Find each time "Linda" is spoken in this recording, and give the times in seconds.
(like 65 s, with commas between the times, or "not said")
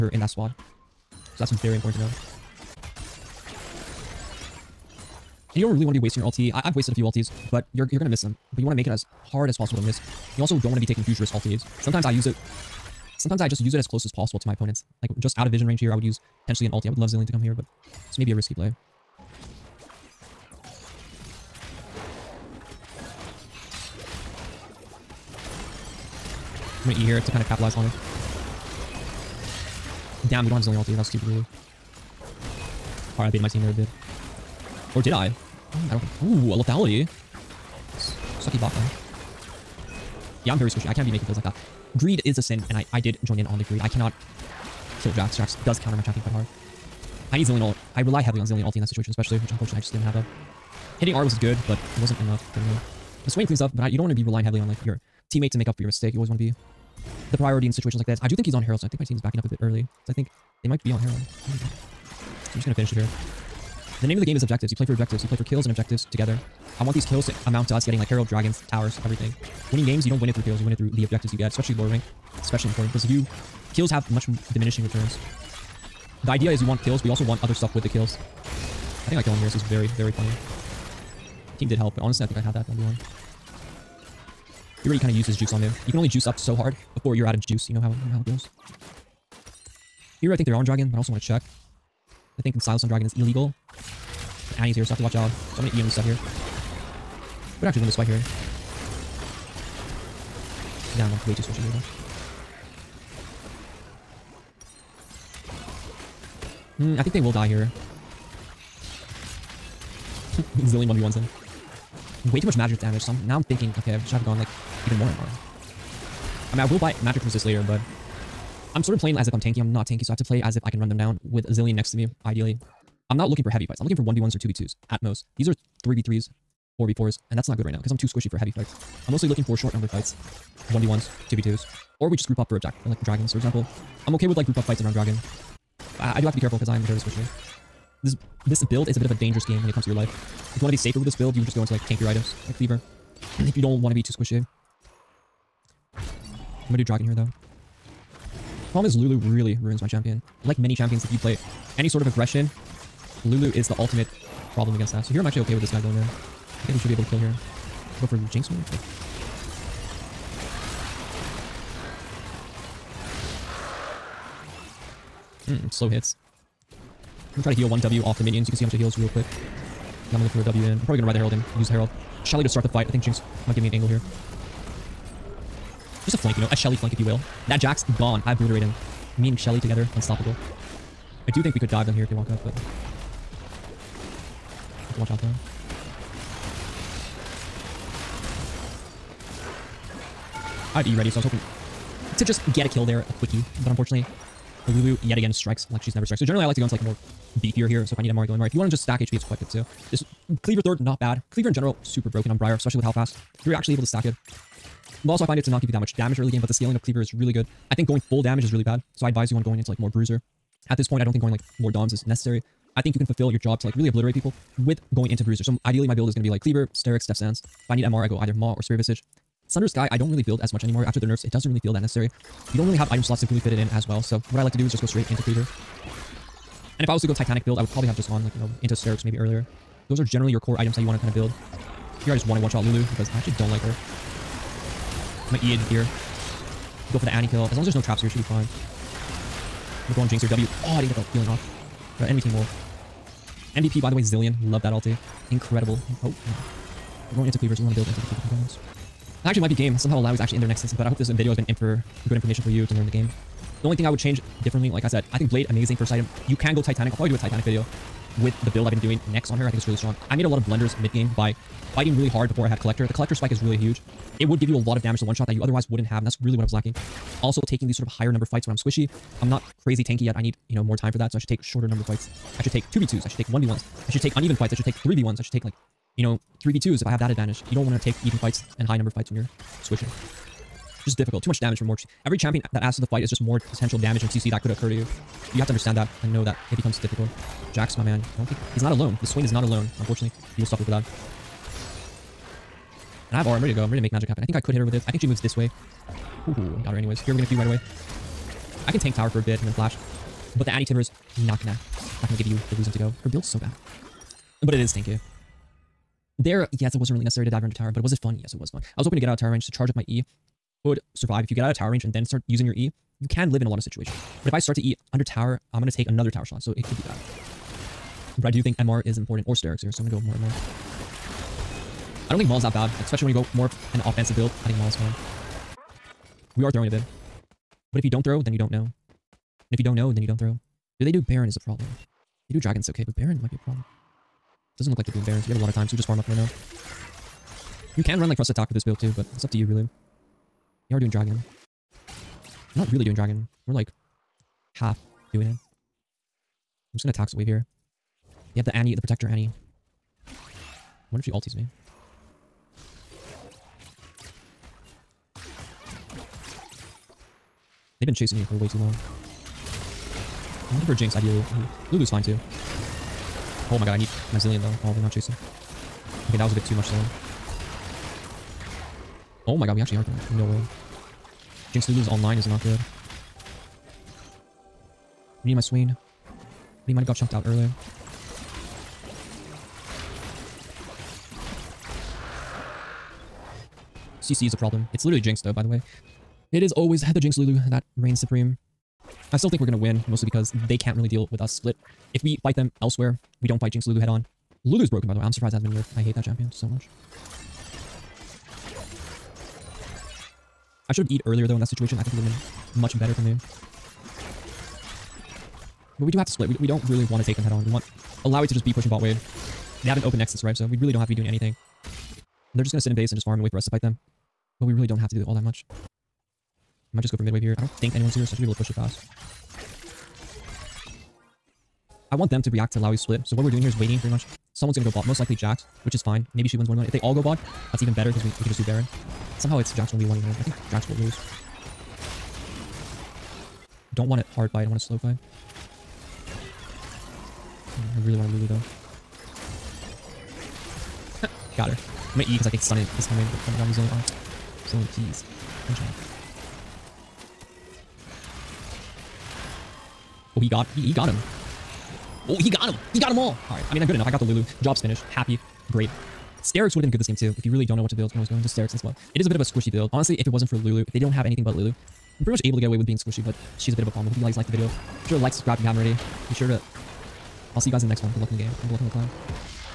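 not said.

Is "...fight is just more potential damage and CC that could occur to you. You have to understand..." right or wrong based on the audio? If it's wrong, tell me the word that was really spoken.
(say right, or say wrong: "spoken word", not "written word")
right.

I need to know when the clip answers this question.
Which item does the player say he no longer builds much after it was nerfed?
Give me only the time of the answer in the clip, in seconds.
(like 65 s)
219 s.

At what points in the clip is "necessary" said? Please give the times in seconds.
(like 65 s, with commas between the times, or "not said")
212 s, 221 s, 307 s.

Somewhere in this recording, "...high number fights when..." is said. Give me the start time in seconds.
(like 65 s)
278 s.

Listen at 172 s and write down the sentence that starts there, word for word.
I think Jinx might give me an angle here.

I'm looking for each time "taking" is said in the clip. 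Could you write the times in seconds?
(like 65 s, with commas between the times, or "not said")
10 s, 267 s.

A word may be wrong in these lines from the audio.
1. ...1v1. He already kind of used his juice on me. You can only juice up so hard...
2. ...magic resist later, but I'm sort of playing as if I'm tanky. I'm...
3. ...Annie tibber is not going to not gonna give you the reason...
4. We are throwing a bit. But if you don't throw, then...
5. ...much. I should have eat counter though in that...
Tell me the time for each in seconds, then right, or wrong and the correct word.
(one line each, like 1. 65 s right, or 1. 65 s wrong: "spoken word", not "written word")
1. 82 s right
2. 117 s right
3. 300 s right
4. 326 s right
5. 396 s wrong: "earlier", not "counter".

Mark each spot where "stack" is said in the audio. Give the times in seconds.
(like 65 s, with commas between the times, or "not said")
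198 s, 203 s.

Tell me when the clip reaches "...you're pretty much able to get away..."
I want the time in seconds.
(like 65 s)
461 s.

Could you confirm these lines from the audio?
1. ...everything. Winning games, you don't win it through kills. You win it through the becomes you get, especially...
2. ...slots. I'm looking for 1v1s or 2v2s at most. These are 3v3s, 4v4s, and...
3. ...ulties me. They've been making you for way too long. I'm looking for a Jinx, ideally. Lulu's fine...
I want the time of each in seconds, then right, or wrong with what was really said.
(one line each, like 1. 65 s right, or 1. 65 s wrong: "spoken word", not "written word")
1. 69 s wrong: "objectives", not "becomes"
2. 123 s wrong: "fights", not "slots"
3. 351 s wrong: "chasing", not "making".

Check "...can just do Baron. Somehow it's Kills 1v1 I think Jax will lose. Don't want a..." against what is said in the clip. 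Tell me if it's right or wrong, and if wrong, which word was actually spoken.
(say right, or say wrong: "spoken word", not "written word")
wrong: "Jax", not "Kills".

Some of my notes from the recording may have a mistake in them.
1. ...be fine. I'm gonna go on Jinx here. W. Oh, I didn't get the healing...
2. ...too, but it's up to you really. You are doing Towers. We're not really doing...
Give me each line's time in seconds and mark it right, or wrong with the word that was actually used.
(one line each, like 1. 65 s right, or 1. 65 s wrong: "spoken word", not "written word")
1. 238 s right
2. 338 s wrong: "Dragon", not "Towers".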